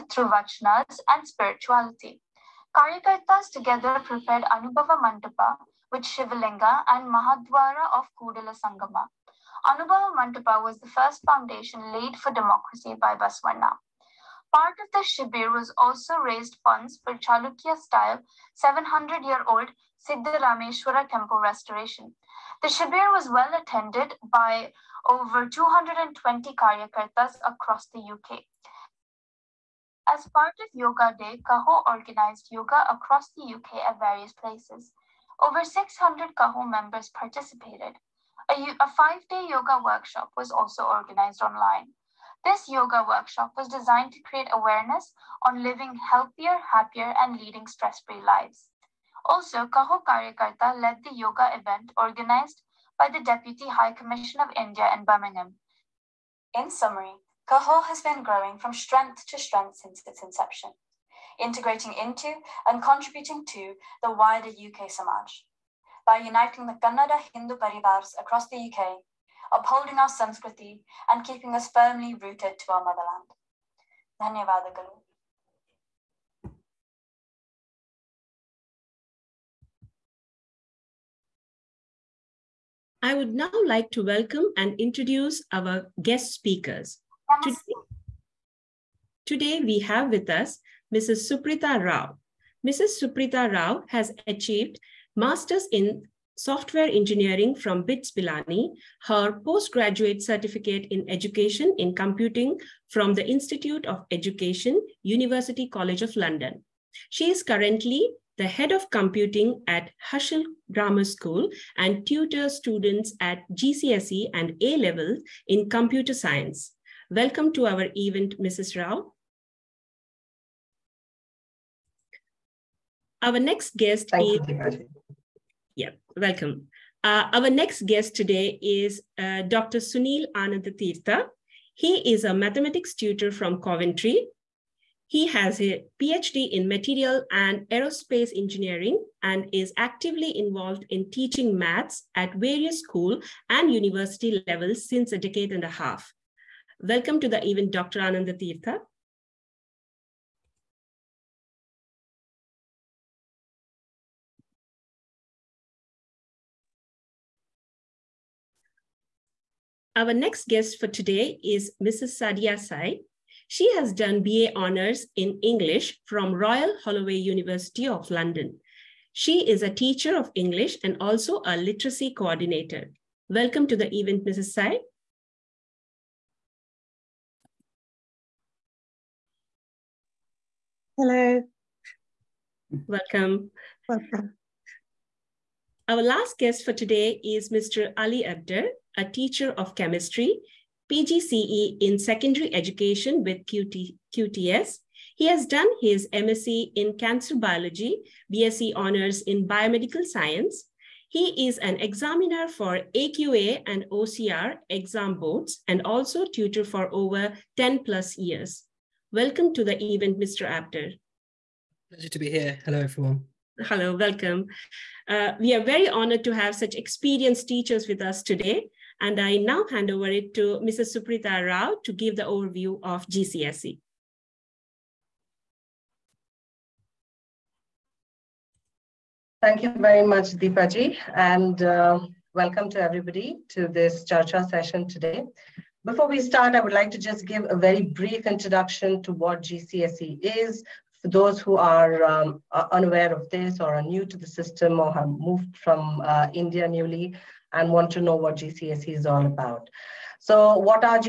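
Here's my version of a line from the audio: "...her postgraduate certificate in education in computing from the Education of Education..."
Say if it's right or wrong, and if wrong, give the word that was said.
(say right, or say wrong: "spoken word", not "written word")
wrong: "Institute", not "Education".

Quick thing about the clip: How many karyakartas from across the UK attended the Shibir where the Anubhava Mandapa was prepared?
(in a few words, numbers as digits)
220.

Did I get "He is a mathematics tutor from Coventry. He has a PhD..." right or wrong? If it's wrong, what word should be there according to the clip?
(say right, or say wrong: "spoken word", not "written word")
right.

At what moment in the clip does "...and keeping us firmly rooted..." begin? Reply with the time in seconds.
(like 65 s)
71 s.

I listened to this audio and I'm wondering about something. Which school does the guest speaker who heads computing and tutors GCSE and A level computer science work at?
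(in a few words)
Herschel Grammar School.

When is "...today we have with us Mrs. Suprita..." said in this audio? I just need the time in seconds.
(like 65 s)
89 s.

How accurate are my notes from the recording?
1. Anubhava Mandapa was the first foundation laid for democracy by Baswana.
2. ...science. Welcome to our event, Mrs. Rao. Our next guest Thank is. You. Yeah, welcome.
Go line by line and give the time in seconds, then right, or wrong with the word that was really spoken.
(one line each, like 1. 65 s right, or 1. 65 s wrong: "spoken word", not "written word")
1. 9 s right
2. 116 s right.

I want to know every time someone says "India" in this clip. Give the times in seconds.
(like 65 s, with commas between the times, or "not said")
54 s, 246 s.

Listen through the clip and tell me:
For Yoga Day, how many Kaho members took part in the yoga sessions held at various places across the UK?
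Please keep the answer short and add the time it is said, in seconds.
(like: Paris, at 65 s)
600, at 35 s.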